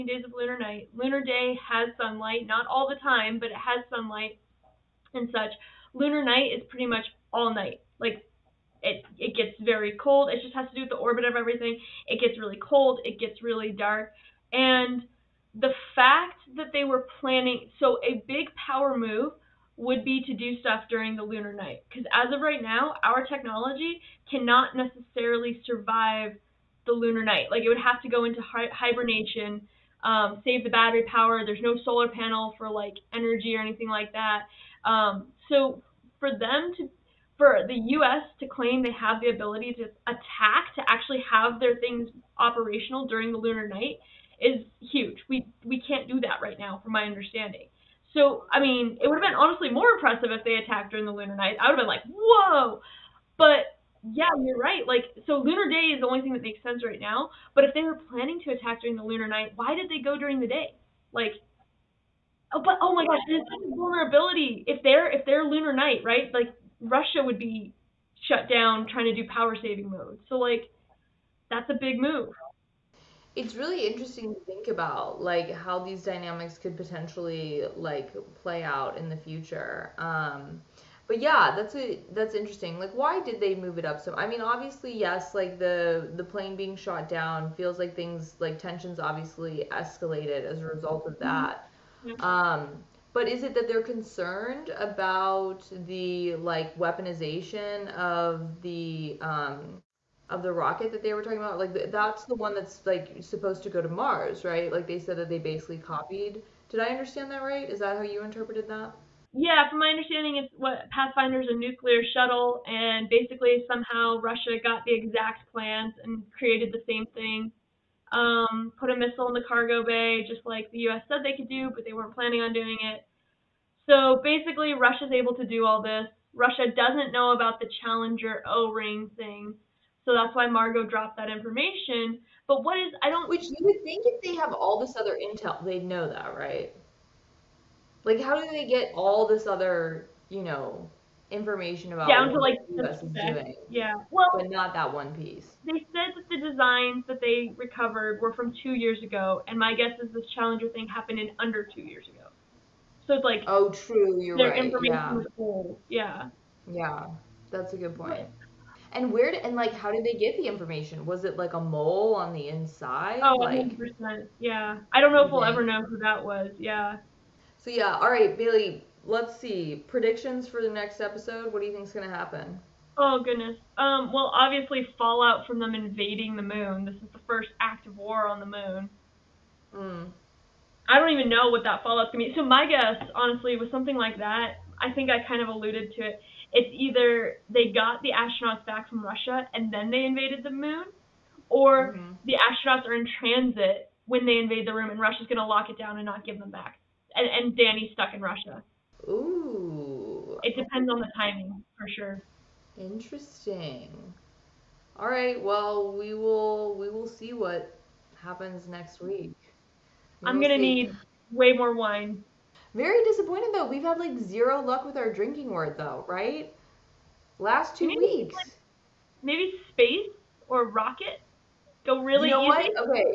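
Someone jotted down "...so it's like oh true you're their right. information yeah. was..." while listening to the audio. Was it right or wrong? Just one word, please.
right.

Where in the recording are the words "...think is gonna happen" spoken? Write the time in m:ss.
2:51.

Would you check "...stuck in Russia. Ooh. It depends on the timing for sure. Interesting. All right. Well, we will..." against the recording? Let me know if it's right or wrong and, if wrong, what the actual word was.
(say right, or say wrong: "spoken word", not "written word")
right.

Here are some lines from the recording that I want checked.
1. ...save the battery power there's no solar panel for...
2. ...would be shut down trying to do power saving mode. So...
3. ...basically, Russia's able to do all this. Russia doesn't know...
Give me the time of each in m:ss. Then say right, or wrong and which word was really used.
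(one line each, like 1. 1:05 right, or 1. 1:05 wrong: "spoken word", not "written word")
1. 0:30 right
2. 1:07 right
3. 2:04 right.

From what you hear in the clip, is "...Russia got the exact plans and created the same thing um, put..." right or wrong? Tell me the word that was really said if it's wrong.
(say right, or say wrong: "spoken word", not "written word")
right.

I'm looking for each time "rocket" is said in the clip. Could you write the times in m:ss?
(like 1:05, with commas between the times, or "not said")
1:40, 3:40.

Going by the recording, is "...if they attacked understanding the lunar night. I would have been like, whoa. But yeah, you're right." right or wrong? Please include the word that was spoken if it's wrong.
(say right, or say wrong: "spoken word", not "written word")
wrong: "during", not "understanding".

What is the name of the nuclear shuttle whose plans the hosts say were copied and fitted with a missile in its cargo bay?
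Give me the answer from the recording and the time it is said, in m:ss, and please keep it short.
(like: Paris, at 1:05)
Pathfinder, at 1:50.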